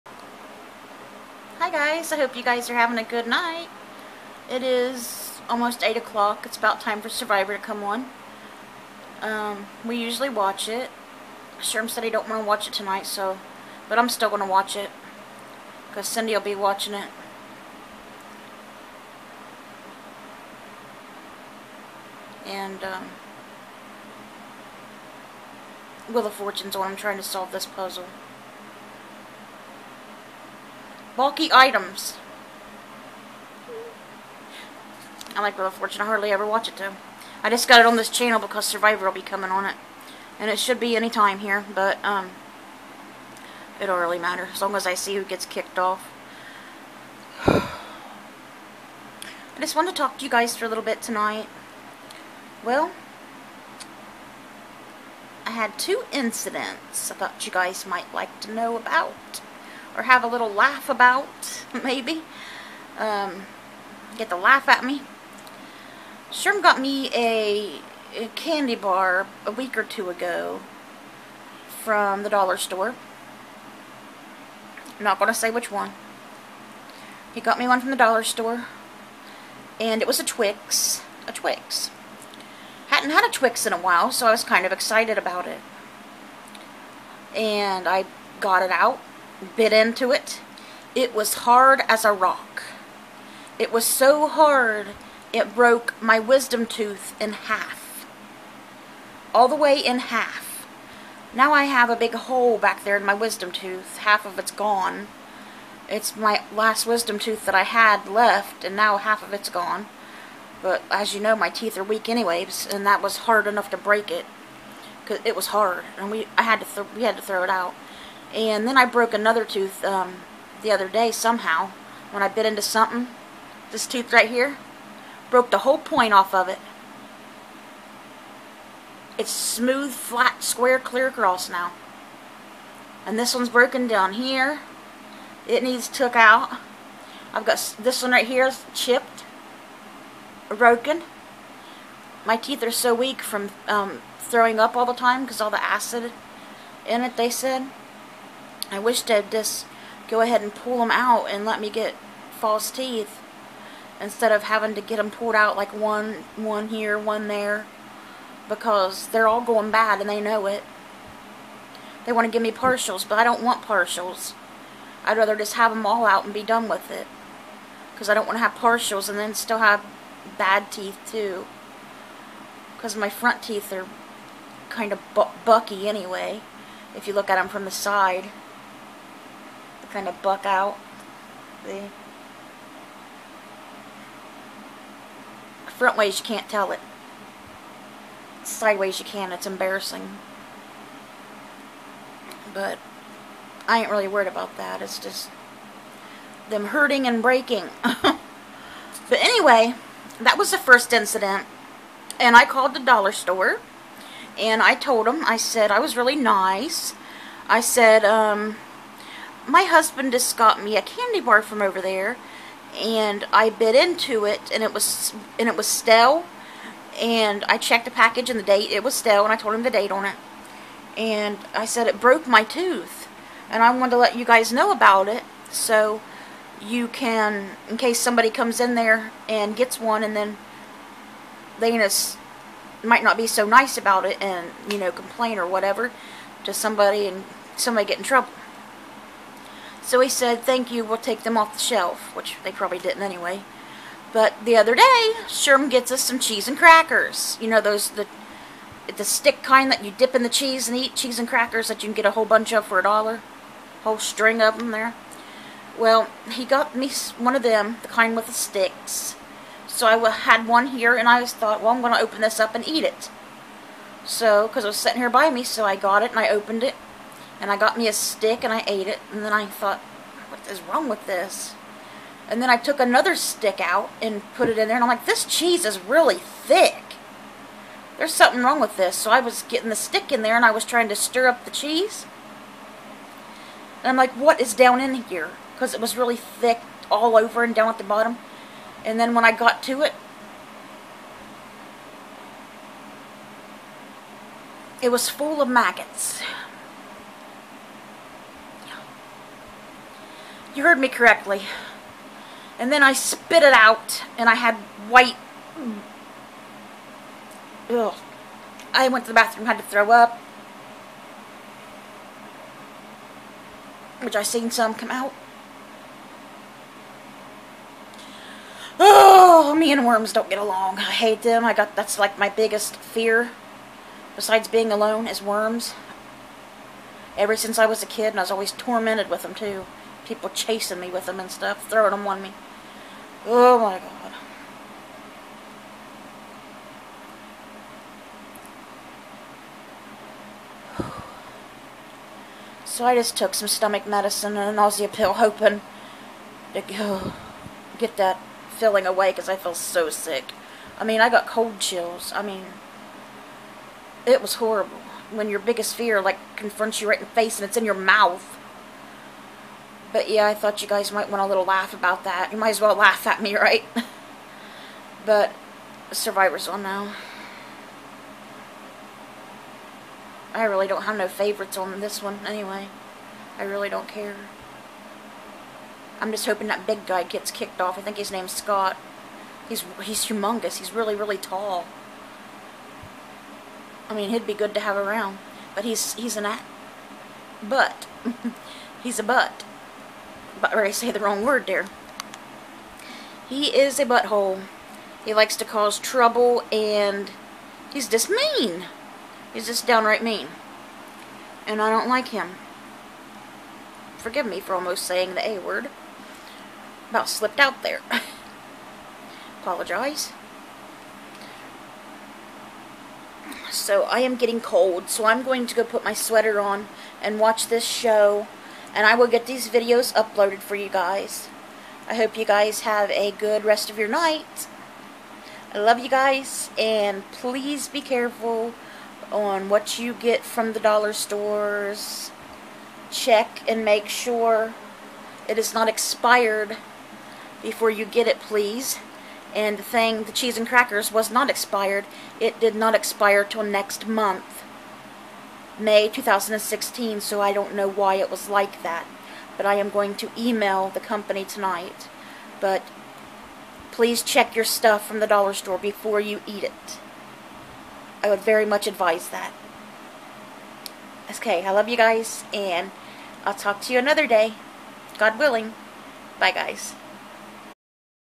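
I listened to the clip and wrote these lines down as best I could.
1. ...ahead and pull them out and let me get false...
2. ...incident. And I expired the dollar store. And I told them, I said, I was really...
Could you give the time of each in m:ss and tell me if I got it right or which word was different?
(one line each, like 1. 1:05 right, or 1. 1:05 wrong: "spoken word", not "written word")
1. 2:30 right
2. 3:20 wrong: "called", not "expired".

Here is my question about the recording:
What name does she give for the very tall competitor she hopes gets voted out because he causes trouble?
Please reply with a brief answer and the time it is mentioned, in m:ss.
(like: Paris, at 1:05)
Scott, at 6:18.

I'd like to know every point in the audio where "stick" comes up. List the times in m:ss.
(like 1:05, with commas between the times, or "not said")
4:09, 4:18, 4:27, 4:33, 4:39.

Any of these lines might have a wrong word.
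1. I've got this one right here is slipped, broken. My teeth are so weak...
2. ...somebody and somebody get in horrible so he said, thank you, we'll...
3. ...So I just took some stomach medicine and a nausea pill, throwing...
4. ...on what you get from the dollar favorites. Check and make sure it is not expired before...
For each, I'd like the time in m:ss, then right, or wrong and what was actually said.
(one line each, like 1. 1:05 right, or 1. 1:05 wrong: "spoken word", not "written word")
1. 2:17 wrong: "chipped", not "slipped"
2. 3:56 wrong: "trouble", not "horrible"
3. 5:42 wrong: "hoping", not "throwing"
4. 7:09 wrong: "stores", not "favorites".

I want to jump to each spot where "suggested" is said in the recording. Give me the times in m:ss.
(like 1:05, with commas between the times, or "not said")
not said.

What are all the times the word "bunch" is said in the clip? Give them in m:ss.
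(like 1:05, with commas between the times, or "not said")
4:12.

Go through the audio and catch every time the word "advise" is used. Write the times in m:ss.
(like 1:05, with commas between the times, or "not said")
7:38.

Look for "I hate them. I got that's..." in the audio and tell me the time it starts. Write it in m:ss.
5:20.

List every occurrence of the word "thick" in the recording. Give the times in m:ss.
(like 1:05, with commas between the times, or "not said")
4:36, 4:46.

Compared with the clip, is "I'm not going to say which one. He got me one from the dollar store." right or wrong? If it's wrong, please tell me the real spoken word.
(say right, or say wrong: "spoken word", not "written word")
right.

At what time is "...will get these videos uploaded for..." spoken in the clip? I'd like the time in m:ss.
6:58.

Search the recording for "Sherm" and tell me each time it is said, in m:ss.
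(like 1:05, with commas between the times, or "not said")
0:11, 1:06, 4:05.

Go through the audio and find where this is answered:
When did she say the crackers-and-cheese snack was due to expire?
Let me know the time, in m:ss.
7:25.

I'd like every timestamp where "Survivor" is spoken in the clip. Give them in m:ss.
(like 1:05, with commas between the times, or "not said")
0:07, 0:38, 6:05.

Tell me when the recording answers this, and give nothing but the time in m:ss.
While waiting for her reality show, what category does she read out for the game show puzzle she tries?
0:31.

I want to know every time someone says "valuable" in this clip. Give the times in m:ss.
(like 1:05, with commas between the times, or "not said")
not said.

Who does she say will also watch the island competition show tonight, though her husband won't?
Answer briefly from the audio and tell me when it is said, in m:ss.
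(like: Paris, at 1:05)
Cindy, at 0:16.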